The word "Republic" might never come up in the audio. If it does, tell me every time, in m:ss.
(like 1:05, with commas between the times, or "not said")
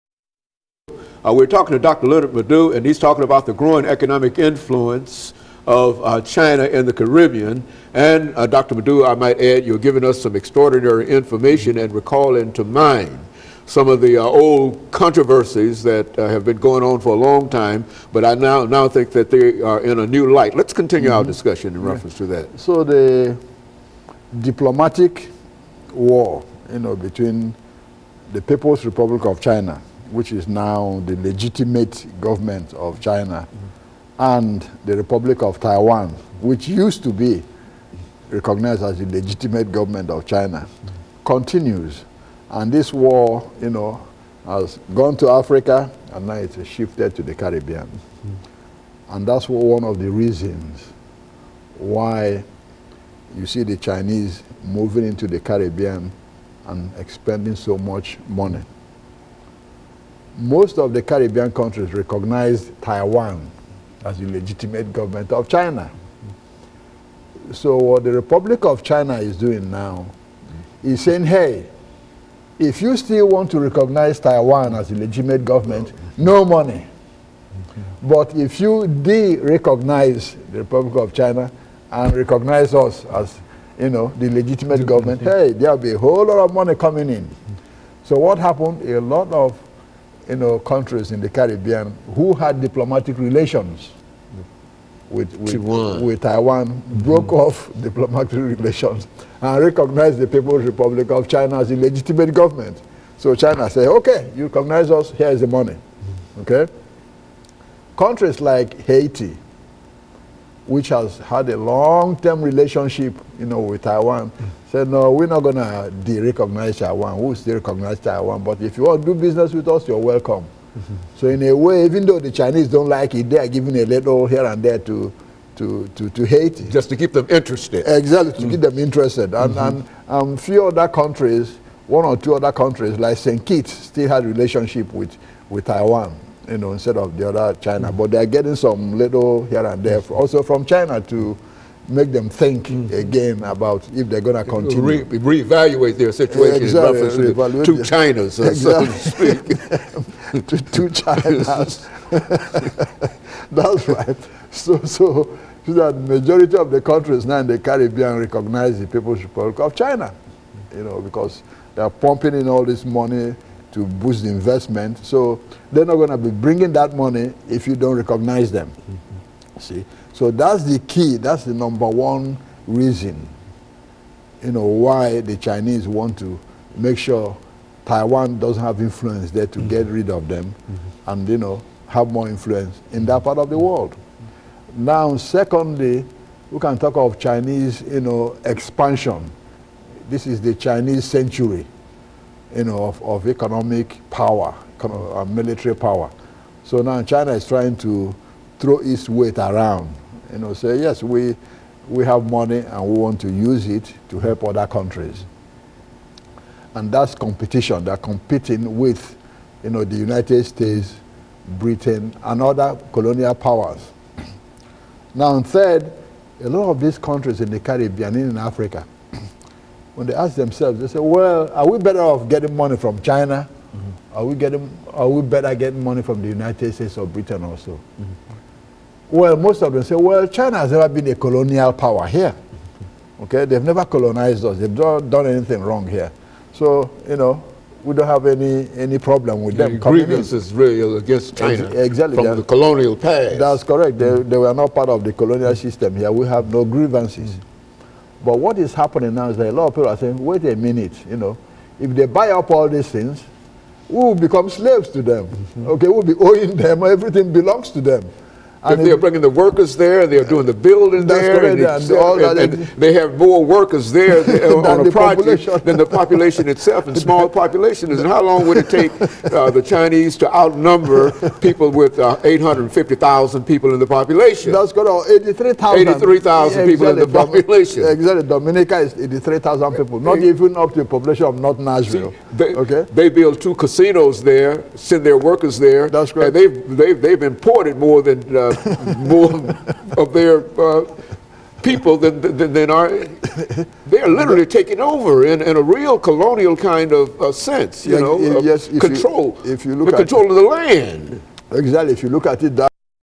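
0:28, 0:34, 1:08, 1:20, 1:40, 2:39.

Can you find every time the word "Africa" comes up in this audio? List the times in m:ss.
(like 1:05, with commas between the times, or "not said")
0:45, 3:38.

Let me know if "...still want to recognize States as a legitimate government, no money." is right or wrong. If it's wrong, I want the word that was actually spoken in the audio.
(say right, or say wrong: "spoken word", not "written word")
wrong: "Taiwan", not "States".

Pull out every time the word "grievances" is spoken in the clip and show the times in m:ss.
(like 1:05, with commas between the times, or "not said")
3:59, 4:06.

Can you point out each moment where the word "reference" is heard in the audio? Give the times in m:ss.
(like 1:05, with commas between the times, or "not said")
0:21, 2:27.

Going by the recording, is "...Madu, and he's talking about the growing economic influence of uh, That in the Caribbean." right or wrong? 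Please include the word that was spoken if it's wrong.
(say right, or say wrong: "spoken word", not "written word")
wrong: "China", not "That".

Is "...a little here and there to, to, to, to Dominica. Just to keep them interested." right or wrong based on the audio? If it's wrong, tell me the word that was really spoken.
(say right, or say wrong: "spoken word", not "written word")
wrong: "Haiti", not "Dominica".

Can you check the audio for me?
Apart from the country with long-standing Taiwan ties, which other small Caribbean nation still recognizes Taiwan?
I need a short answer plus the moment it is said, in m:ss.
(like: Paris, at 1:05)
St. Kitts, at 2:13.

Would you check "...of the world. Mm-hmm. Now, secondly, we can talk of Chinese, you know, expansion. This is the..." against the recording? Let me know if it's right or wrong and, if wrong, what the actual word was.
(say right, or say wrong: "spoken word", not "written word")
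right.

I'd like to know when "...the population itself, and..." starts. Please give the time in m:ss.
4:25.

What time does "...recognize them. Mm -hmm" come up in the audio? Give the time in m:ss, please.
2:47.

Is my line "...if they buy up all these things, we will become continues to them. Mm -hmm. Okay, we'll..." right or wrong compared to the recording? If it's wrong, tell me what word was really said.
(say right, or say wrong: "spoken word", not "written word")
wrong: "slaves", not "continues".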